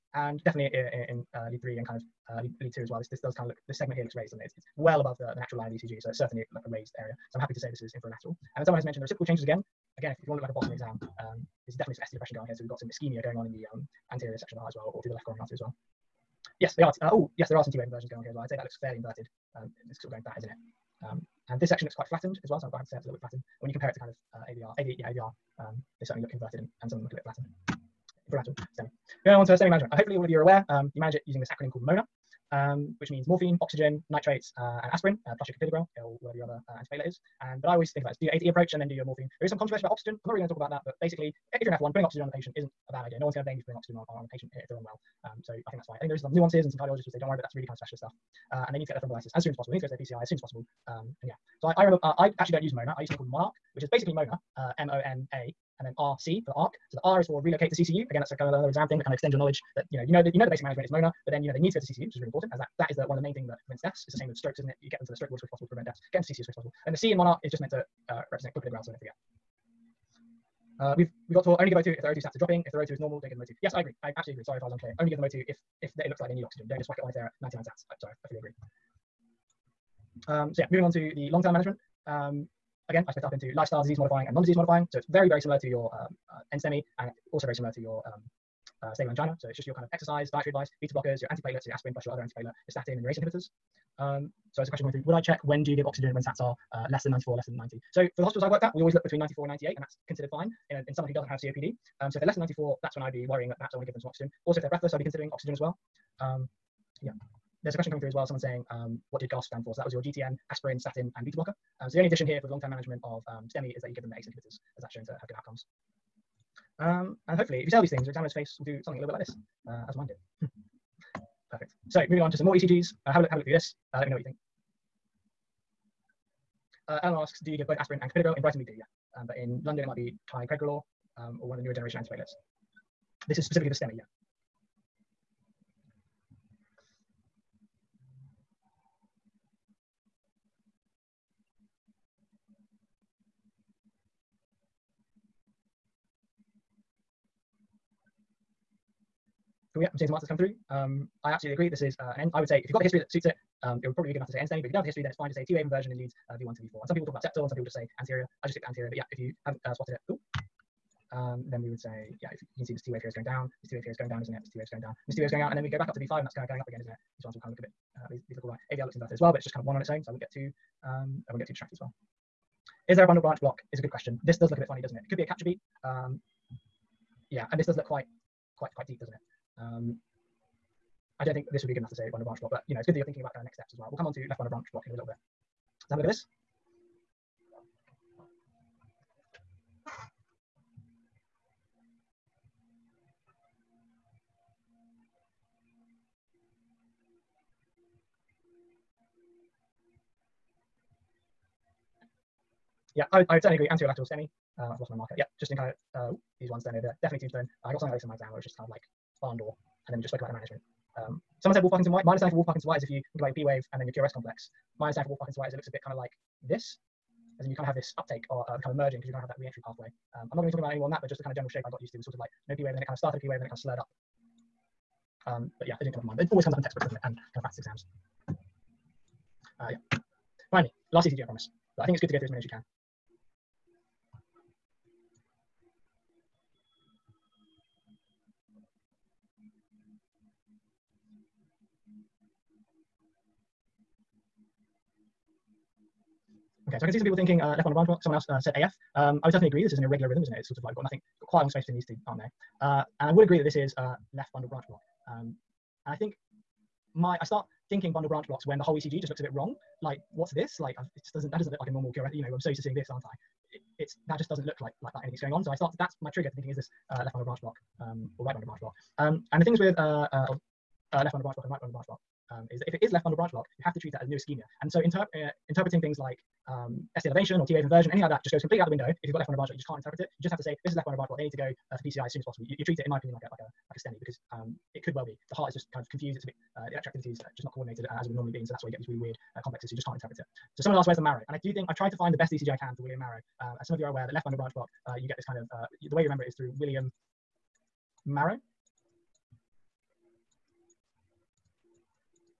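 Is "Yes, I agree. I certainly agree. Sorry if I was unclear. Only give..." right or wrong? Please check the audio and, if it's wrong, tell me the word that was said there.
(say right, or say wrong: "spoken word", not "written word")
wrong: "absolutely", not "certainly".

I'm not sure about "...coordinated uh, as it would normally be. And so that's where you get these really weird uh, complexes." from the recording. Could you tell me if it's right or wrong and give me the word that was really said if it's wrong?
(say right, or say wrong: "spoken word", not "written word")
right.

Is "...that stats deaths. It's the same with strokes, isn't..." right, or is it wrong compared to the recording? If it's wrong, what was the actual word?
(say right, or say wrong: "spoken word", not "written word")
wrong: "prevents", not "stats".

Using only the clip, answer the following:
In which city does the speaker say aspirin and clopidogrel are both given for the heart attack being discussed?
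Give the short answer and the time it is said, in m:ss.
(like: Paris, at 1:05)
Brighton, at 2:08.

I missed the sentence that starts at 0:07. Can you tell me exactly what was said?
So I'm happy to say this is inferolateral.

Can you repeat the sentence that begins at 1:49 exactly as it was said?
So that was your GTN, aspirin, statin, and beta blocker.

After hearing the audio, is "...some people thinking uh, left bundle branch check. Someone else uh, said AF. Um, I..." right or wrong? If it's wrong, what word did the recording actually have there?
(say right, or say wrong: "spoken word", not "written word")
wrong: "block", not "check".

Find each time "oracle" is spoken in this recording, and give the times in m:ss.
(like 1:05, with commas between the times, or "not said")
not said.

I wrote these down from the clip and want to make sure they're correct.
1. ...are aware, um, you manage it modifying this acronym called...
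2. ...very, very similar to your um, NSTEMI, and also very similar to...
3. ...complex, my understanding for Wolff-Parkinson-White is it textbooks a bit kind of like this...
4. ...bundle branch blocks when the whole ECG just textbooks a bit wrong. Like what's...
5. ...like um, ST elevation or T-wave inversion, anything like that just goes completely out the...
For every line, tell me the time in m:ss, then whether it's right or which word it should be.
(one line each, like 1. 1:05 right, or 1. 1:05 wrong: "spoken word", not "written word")
1. 0:30 wrong: "using", not "modifying"
2. 1:25 right
3. 3:34 wrong: "looks", not "textbooks"
4. 4:17 wrong: "looks", not "textbooks"
5. 4:35 right.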